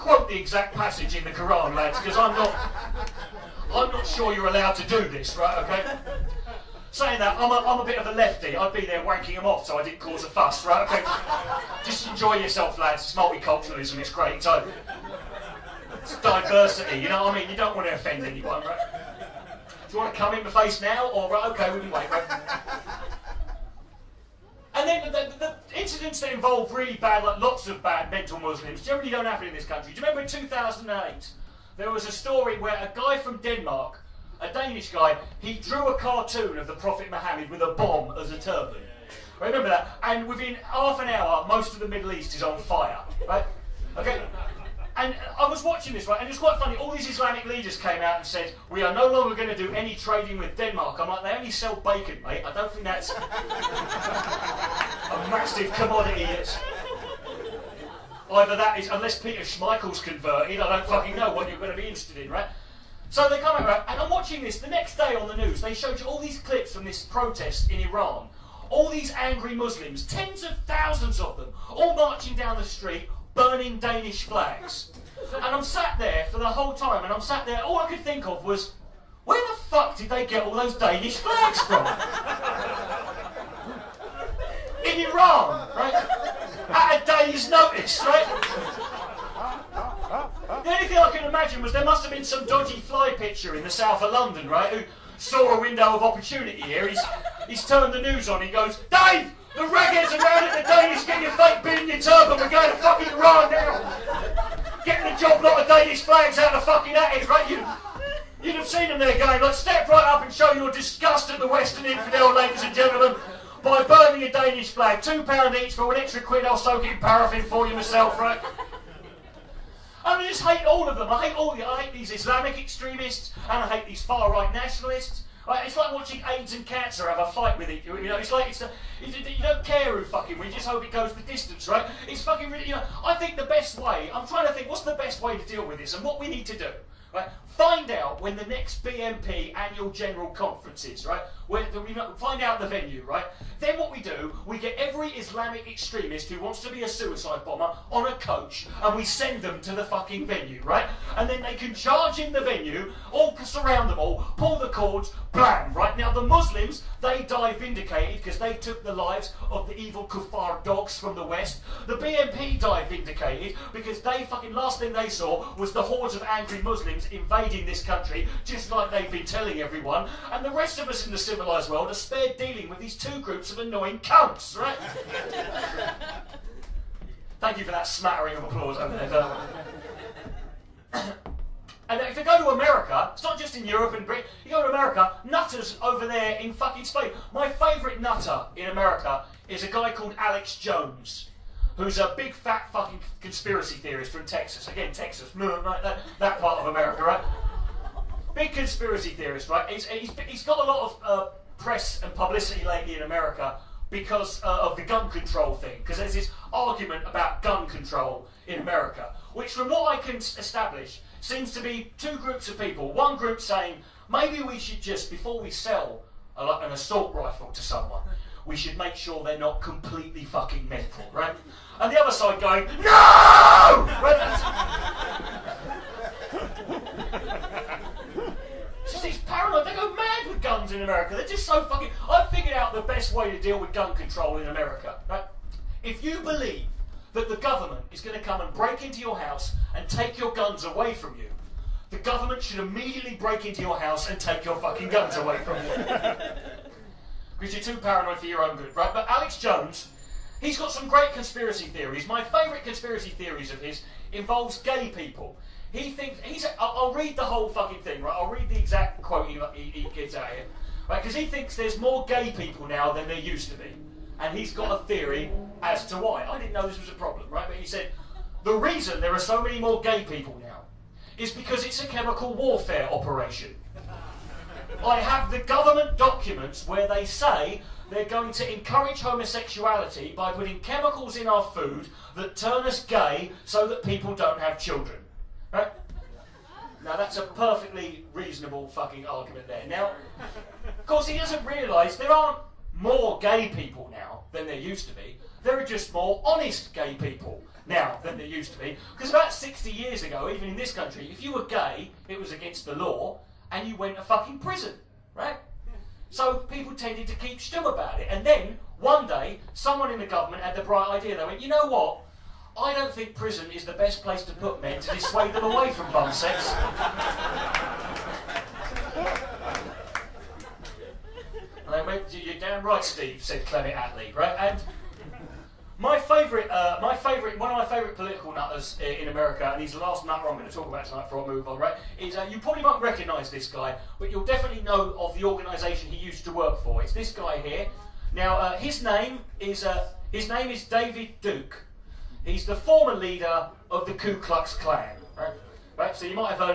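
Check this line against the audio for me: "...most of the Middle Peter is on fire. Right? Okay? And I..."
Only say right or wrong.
wrong.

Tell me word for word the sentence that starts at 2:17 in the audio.
Right, find out when the next BNP annual general conference is.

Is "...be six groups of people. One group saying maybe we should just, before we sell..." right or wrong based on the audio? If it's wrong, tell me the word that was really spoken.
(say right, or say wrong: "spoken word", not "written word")
wrong: "two", not "six".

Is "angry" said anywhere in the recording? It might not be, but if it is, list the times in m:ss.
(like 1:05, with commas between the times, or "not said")
1:09, 2:46.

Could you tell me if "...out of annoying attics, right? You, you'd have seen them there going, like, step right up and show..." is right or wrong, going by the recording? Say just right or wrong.
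wrong.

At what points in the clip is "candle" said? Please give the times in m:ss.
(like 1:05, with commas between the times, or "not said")
not said.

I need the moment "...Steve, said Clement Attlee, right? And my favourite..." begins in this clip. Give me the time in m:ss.
5:22.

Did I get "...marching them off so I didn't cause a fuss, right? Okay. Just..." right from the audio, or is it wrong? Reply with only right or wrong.
wrong.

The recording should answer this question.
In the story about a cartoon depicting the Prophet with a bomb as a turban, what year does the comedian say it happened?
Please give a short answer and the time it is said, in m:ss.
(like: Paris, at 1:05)
2008, at 0:30.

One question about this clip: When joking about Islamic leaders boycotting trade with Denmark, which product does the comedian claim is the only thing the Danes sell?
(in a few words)
Bacon.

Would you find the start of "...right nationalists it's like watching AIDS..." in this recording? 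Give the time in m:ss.
2:04.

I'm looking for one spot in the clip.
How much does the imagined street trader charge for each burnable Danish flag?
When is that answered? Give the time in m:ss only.
1:55.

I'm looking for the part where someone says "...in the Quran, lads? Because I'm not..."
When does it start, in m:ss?
0:01.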